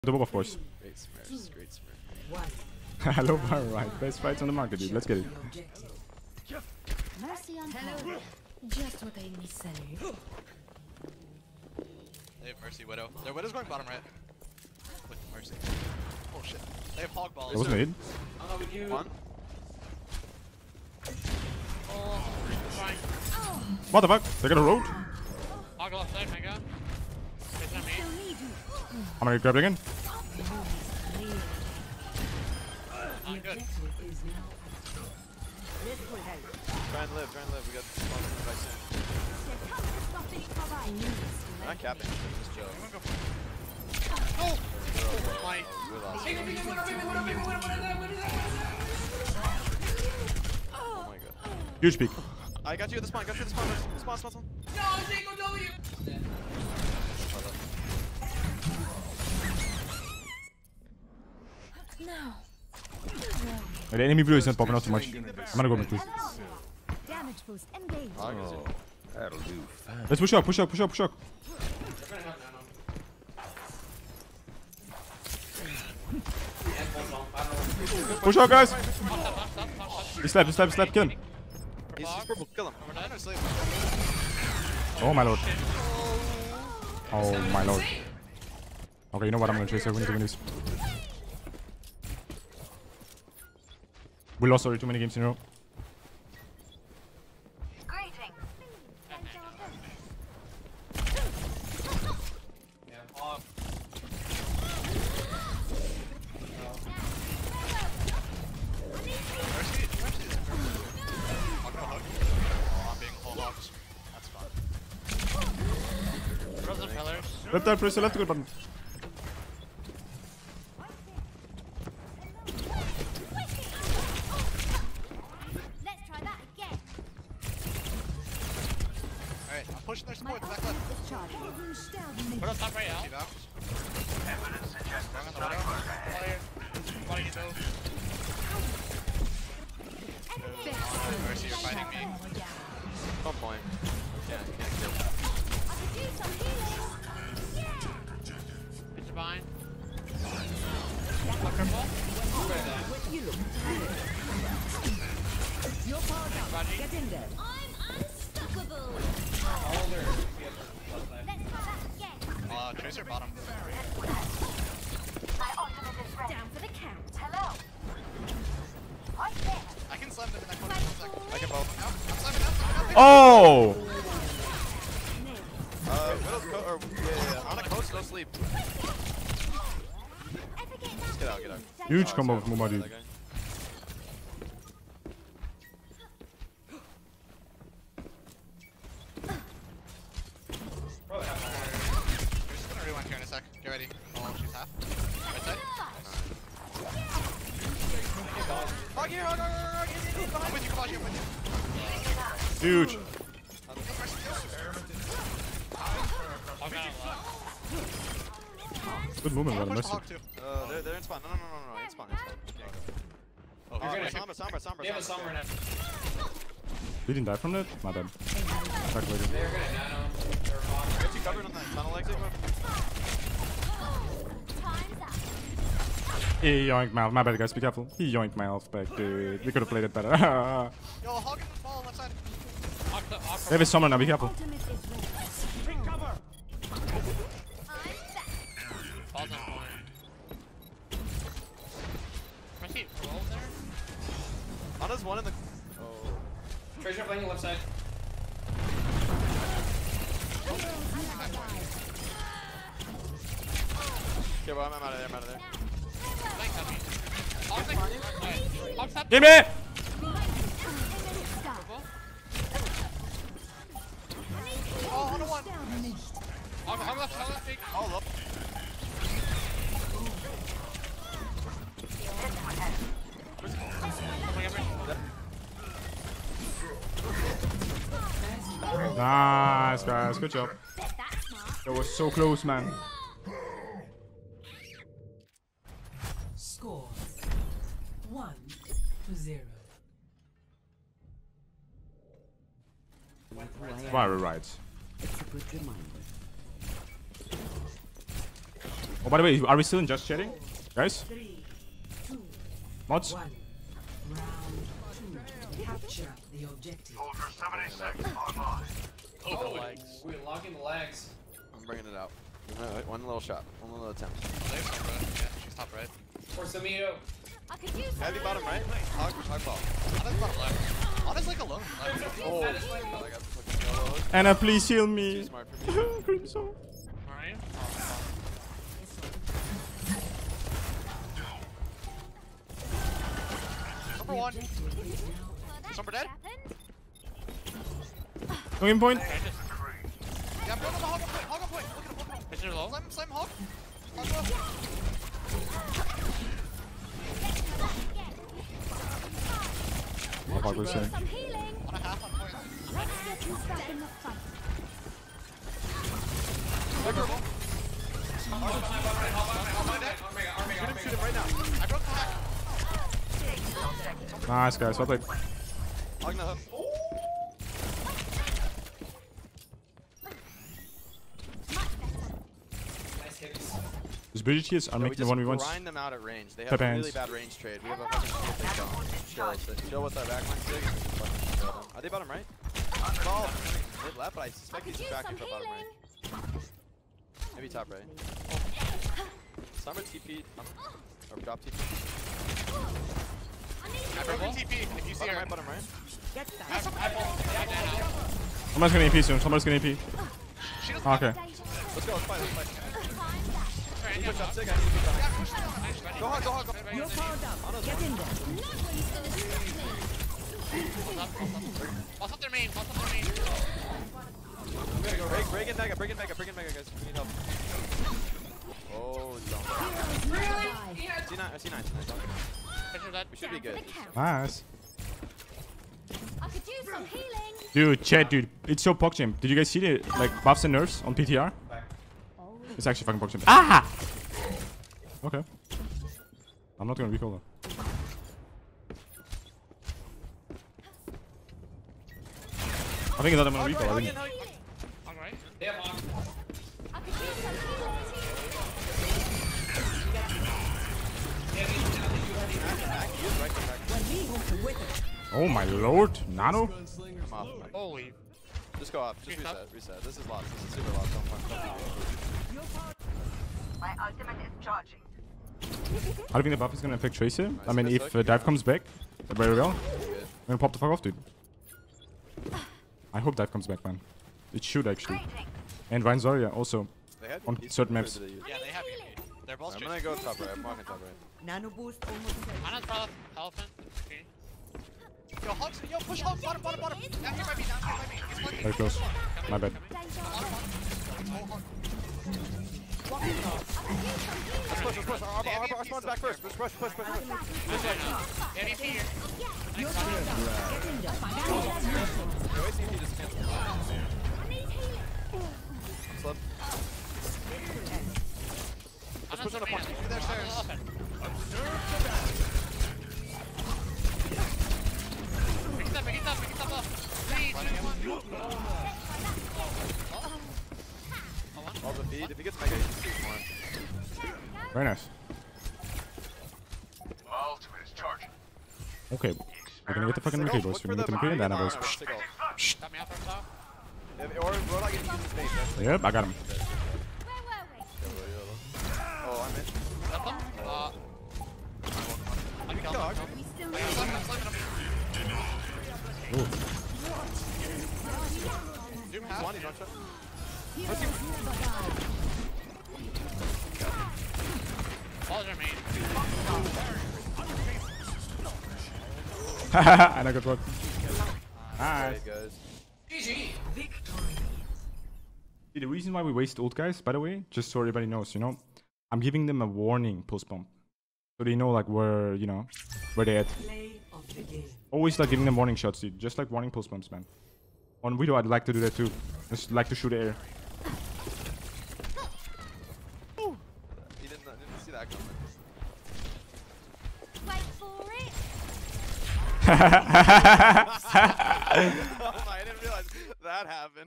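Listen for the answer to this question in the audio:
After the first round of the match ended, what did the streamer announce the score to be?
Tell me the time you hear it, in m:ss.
4:48.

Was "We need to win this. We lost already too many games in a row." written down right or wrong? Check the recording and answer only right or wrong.
right.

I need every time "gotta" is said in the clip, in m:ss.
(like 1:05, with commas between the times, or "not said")
6:54.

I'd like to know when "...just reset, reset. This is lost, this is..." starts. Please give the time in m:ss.
7:39.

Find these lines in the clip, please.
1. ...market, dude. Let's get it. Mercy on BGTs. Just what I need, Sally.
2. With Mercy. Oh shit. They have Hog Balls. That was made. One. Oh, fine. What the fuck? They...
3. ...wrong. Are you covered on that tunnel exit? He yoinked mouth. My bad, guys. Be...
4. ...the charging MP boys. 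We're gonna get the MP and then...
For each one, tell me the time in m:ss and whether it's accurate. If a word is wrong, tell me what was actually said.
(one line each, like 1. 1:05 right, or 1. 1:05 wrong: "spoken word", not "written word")
1. 0:04 wrong: "Hello", not "BGTs"
2. 0:15 right
3. 3:40 right
4. 8:49 wrong: "fucking", not "charging".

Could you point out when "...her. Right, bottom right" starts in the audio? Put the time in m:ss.
6:35.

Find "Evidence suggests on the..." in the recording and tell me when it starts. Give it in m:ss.
2:13.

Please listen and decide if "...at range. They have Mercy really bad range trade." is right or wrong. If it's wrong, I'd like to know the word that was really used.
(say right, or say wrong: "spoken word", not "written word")
wrong: "Pep", not "Mercy".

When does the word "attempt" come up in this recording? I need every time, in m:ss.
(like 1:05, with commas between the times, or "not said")
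5:13.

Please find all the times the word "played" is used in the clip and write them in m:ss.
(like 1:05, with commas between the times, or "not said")
3:49, 6:04.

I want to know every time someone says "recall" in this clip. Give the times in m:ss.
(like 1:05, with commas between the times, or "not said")
7:16, 7:23.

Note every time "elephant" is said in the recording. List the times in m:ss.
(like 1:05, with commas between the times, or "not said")
8:03.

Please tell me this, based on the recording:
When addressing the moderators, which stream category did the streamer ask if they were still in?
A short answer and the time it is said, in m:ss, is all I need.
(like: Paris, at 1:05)
Just chatting, at 4:59.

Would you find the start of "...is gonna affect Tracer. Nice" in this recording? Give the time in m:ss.
7:46.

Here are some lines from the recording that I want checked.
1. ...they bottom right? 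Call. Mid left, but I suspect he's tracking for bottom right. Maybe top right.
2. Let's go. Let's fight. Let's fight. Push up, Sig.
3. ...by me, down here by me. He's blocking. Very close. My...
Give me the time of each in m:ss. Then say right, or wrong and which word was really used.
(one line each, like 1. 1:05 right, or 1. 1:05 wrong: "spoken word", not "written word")
1. 6:21 right
2. 6:41 right
3. 8:07 right.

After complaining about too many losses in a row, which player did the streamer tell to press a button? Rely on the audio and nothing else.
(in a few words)
Reptile.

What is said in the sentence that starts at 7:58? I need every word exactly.
Yeah, they're both I'm gonna go top right.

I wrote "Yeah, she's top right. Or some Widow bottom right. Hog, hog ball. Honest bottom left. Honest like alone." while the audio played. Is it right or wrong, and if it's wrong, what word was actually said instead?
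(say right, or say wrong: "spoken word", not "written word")
wrong: "Heavy", not "Widow".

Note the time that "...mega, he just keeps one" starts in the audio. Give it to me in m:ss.
8:42.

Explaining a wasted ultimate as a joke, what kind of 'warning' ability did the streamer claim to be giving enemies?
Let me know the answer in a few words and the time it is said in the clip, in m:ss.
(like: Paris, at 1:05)
warning pulse bomb, at 9:29.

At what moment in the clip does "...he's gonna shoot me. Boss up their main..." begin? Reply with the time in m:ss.
6:48.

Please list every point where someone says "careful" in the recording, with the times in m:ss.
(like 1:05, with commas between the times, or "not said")
3:47, 3:54.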